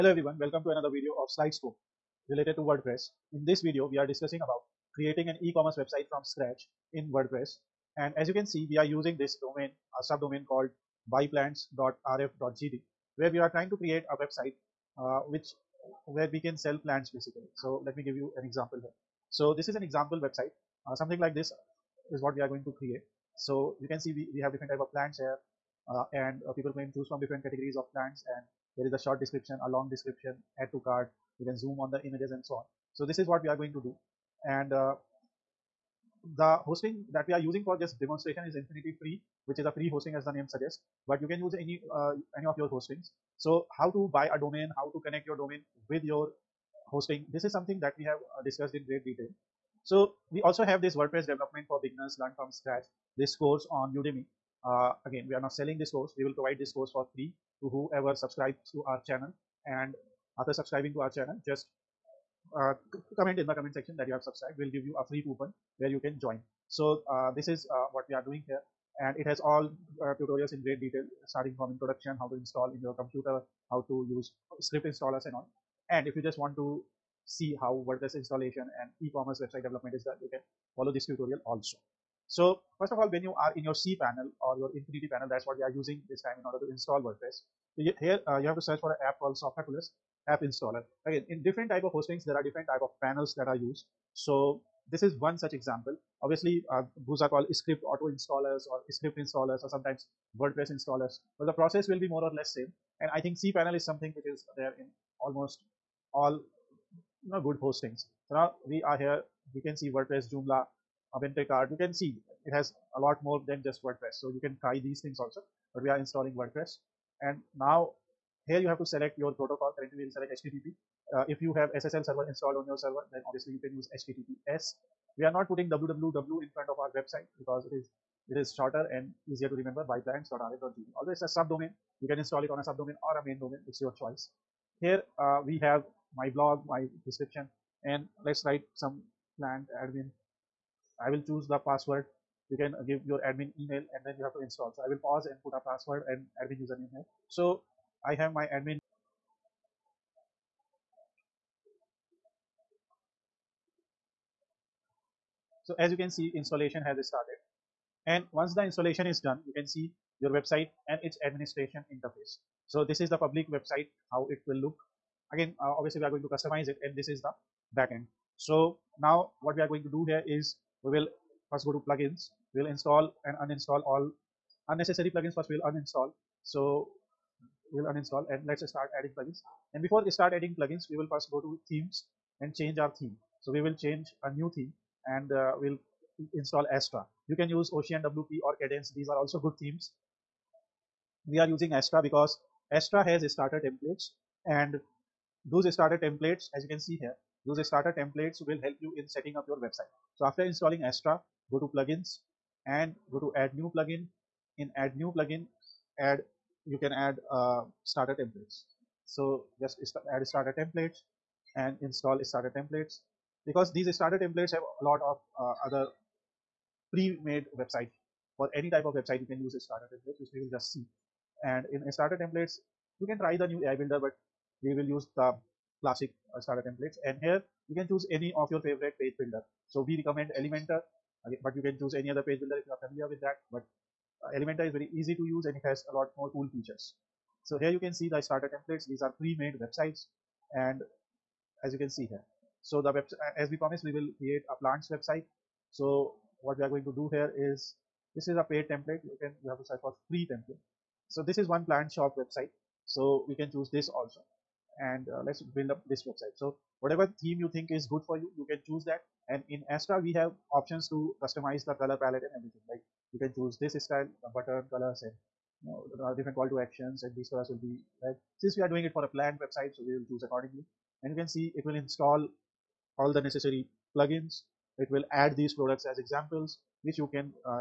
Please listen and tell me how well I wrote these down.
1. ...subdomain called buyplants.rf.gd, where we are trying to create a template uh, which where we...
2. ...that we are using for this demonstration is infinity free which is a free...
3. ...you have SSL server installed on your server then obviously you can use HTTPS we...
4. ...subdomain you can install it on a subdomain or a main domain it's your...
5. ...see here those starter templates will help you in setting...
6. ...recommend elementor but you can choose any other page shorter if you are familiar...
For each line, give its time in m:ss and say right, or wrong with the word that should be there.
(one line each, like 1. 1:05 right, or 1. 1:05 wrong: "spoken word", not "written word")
1. 0:10 wrong: "website", not "template"
2. 0:37 right
3. 2:01 right
4. 2:11 right
5. 3:16 right
6. 3:50 wrong: "builder", not "shorter".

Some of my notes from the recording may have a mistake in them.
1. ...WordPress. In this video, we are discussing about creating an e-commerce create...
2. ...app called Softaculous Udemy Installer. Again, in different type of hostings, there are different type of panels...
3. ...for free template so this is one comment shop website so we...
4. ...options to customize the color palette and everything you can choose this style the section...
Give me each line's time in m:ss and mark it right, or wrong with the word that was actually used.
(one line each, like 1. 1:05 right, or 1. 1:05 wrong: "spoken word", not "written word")
1. 0:02 wrong: "website", not "create"
2. 1:29 wrong: "App", not "Udemy"
3. 4:09 wrong: "plant", not "comment"
4. 4:20 wrong: "button", not "section".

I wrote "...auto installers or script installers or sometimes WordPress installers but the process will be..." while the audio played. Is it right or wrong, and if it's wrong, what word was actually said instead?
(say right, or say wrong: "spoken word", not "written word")
right.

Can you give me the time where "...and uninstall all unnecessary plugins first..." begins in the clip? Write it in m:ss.
2:53.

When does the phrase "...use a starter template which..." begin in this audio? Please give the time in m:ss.
3:39.